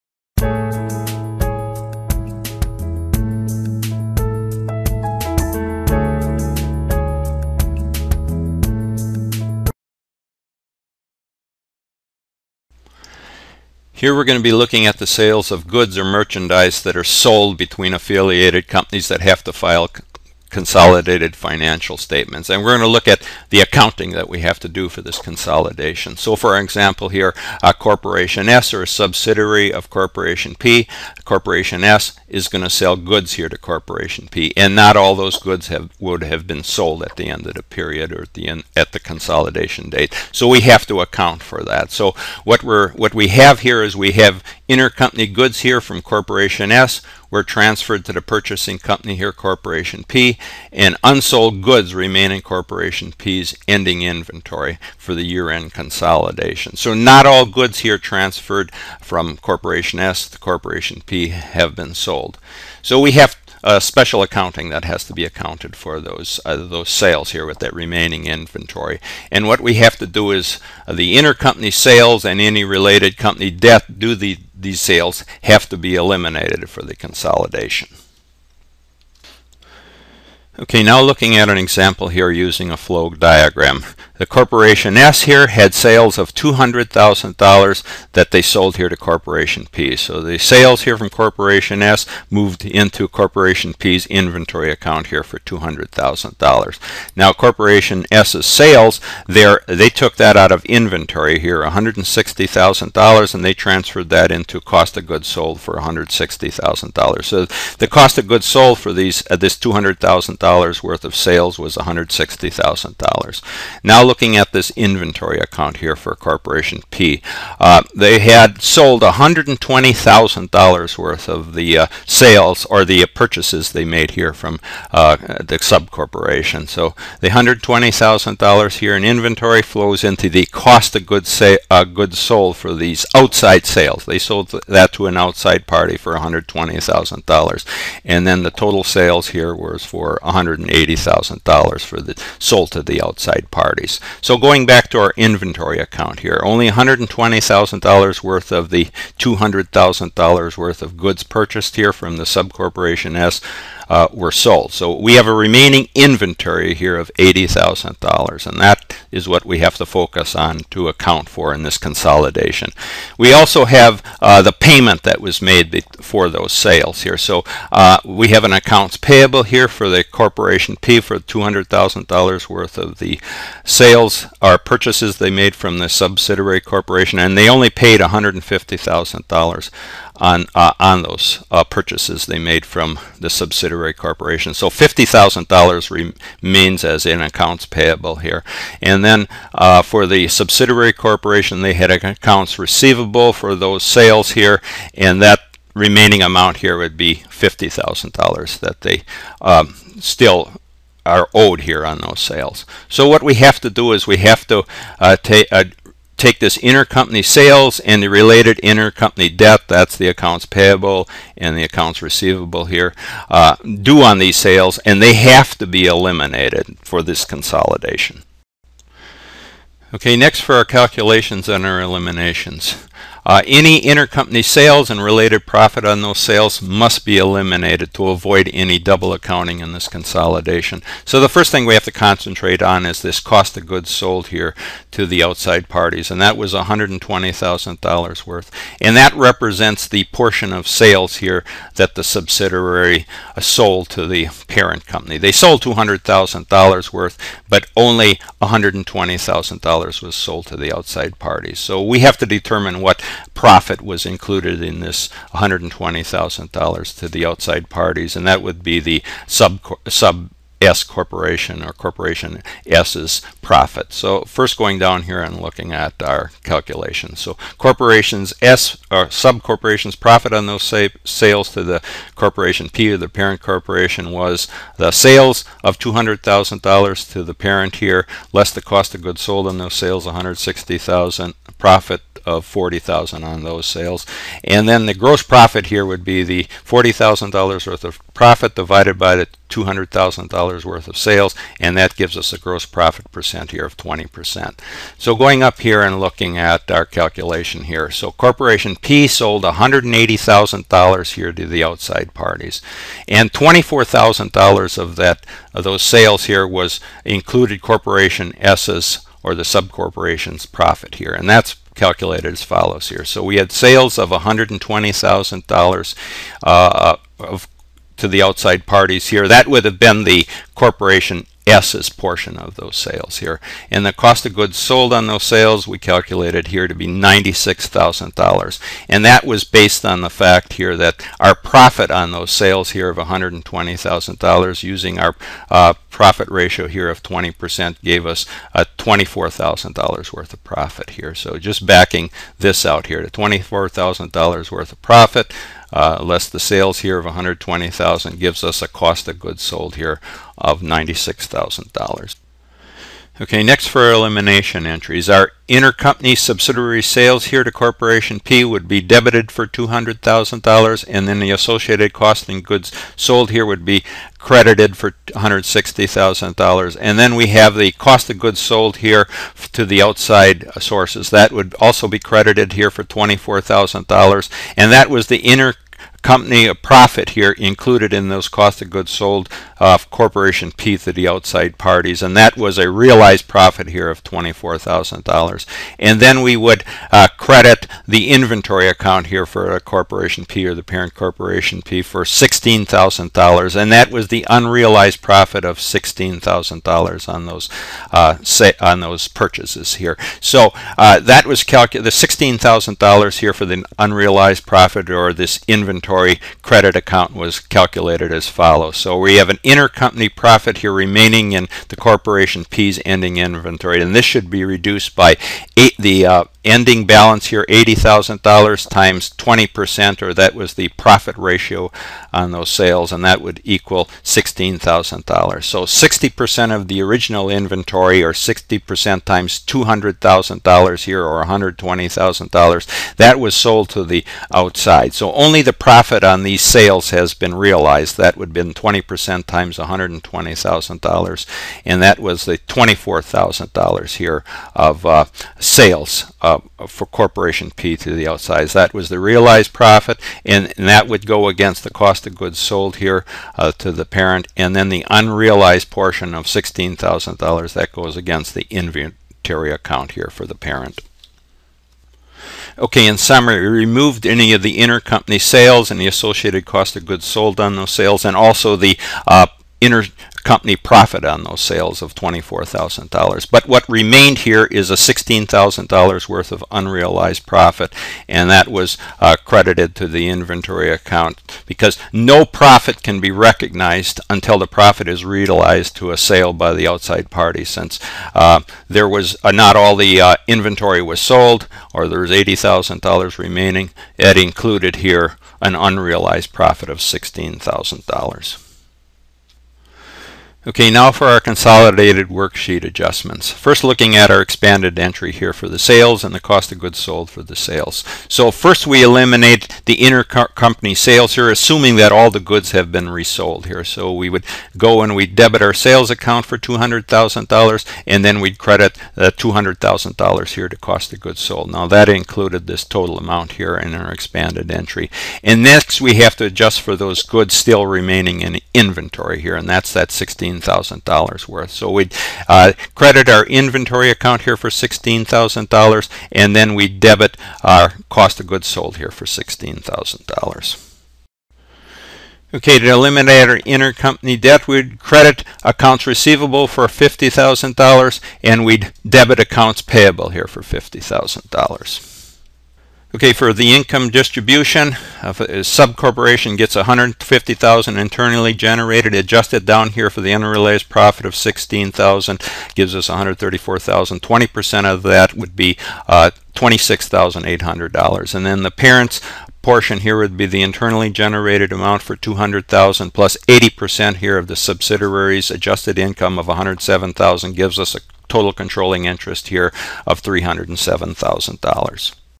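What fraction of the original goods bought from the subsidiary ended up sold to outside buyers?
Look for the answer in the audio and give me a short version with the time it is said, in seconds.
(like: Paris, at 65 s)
60%, at 425 s.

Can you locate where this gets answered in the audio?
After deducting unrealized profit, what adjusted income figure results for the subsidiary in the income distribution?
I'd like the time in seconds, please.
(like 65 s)
562 s.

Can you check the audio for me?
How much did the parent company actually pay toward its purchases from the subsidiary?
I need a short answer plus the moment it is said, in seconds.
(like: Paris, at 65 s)
$150,000, at 177 s.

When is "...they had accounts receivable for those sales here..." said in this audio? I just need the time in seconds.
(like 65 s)
191 s.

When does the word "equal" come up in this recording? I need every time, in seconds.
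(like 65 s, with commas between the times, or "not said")
423 s.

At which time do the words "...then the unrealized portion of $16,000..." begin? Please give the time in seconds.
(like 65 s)
454 s.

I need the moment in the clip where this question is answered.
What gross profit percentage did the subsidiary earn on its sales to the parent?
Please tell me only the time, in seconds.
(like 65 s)
292 s.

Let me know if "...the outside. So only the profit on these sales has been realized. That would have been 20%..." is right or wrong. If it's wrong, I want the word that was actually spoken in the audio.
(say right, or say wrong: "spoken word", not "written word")
right.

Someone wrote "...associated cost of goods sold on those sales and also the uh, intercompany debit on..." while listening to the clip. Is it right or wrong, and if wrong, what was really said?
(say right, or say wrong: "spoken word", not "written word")
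wrong: "profit", not "debit".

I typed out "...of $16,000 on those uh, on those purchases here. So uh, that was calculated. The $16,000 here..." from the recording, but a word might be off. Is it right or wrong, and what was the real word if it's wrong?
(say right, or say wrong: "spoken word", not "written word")
right.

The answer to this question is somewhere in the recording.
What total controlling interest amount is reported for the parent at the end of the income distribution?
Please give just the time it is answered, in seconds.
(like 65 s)
580 s.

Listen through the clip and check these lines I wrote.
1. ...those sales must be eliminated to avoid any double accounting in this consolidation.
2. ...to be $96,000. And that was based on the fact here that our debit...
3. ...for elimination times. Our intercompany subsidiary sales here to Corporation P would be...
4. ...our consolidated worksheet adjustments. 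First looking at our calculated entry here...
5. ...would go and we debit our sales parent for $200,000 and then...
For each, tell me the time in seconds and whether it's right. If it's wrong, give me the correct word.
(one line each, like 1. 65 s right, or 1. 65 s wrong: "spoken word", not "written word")
1. 226 s right
2. 326 s wrong: "profit", not "debit"
3. 353 s wrong: "entries", not "times"
4. 501 s wrong: "expanded", not "calculated"
5. 514 s wrong: "account", not "parent".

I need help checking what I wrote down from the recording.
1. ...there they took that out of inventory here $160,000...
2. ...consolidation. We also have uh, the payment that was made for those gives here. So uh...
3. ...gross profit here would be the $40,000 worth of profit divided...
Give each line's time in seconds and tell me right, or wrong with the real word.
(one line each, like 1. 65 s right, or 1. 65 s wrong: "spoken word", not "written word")
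1. 99 s right
2. 161 s wrong: "sales", not "gives"
3. 284 s right.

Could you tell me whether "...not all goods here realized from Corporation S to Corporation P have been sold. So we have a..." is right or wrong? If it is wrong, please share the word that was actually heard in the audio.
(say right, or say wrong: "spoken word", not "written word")
wrong: "transferred", not "realized".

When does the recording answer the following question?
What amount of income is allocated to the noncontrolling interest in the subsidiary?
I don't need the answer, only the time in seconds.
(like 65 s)
566 s.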